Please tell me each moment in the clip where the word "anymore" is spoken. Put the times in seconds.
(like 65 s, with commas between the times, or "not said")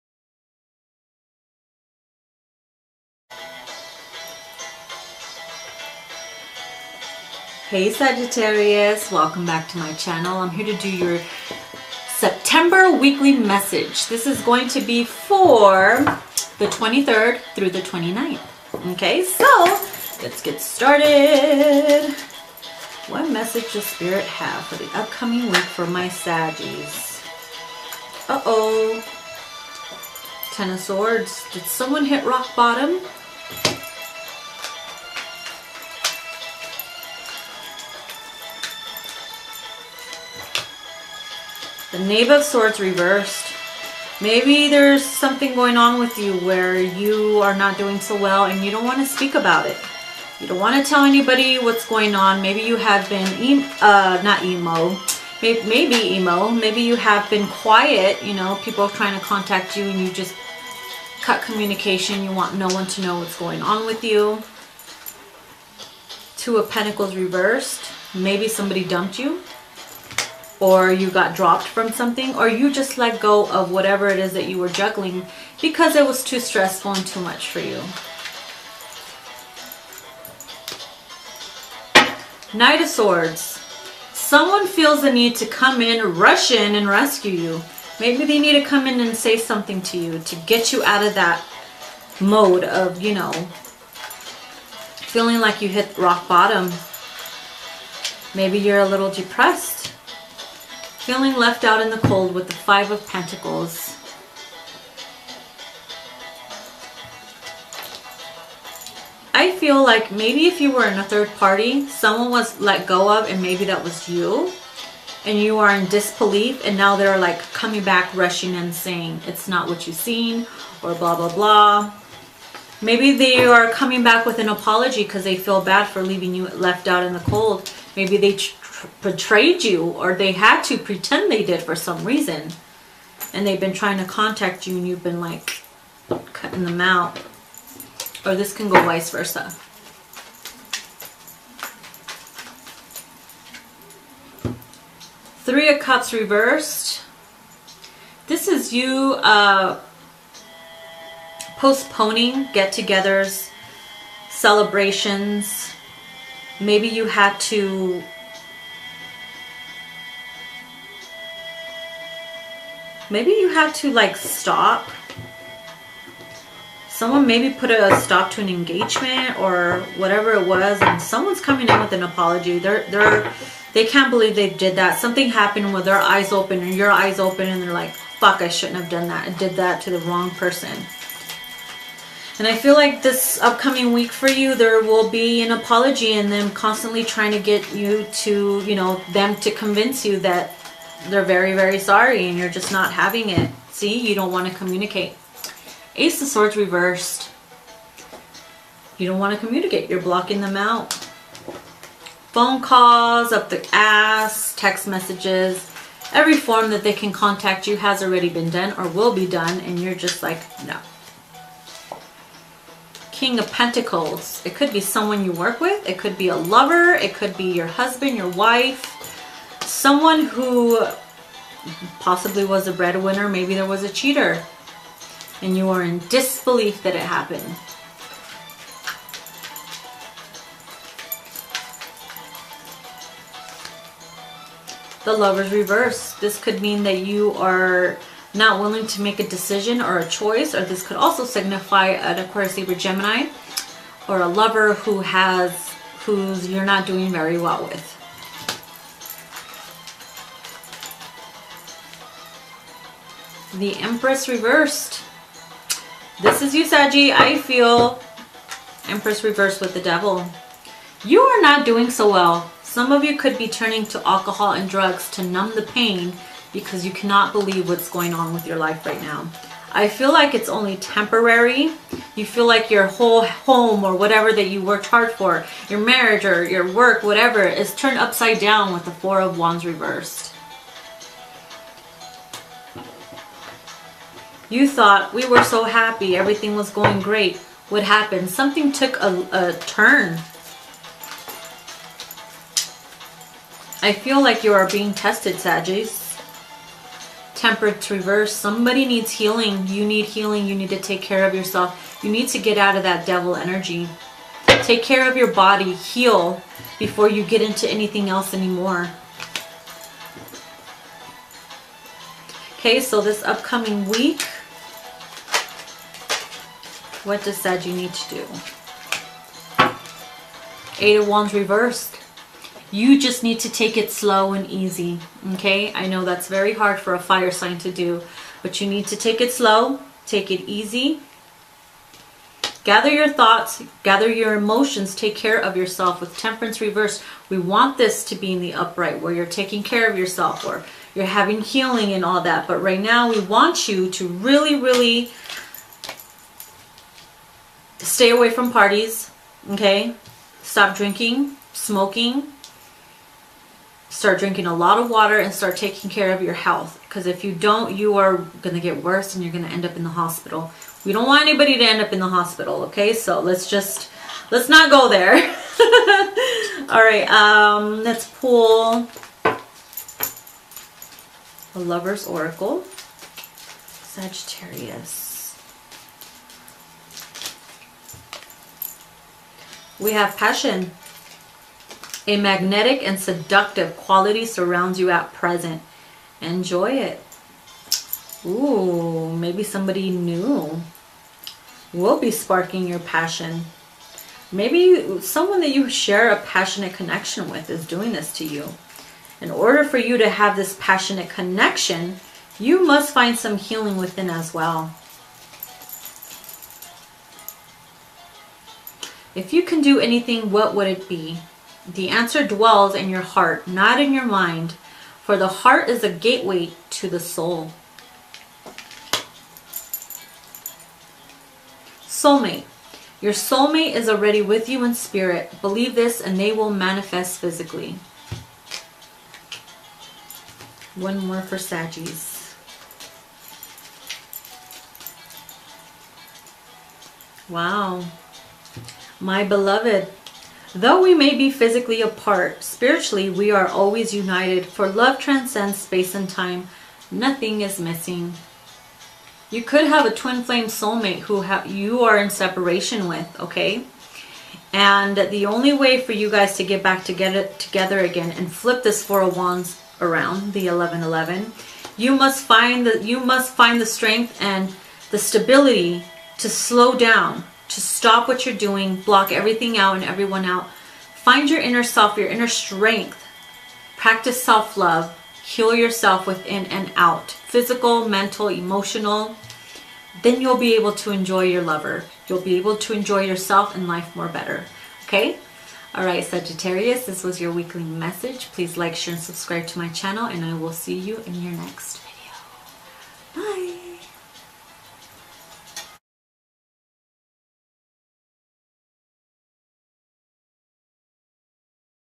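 308 s.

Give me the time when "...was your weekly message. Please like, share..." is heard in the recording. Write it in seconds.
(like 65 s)
487 s.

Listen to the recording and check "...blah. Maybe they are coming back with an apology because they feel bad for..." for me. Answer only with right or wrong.
right.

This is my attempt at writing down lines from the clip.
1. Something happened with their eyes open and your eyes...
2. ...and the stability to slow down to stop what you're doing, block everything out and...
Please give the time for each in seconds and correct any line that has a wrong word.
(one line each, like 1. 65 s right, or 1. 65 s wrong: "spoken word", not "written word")
1. 174 s right
2. 464 s right.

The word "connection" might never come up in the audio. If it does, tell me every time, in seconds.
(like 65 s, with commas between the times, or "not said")
396 s, 401 s.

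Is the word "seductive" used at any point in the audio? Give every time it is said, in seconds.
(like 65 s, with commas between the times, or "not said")
382 s.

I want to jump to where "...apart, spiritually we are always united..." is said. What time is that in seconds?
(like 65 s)
441 s.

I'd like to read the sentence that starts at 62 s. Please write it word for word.
You want no one to know what's going on with you.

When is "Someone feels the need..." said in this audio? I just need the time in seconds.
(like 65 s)
84 s.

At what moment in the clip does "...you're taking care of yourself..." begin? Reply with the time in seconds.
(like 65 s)
339 s.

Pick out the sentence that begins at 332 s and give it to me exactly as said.
Gather your thoughts, gather your emotions, take care of yourself.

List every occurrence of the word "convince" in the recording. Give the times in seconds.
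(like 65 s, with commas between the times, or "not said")
189 s.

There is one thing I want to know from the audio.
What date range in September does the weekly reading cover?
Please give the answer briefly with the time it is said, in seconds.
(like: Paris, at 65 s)
23rd through the 29th, at 16 s.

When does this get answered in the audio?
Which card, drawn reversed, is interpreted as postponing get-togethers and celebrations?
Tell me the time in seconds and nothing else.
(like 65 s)
145 s.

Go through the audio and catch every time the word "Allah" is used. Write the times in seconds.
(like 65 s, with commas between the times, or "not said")
not said.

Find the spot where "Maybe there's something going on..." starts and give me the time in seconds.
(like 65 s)
44 s.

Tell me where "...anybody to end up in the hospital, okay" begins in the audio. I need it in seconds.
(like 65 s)
361 s.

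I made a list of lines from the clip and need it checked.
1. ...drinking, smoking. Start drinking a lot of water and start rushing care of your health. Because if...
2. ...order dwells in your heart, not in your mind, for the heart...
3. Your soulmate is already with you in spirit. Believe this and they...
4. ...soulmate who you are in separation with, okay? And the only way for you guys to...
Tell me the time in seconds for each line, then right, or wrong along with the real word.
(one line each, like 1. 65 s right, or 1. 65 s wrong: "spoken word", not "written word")
1. 350 s wrong: "taking", not "rushing"
2. 411 s wrong: "answer", not "order"
3. 423 s right
4. 450 s right.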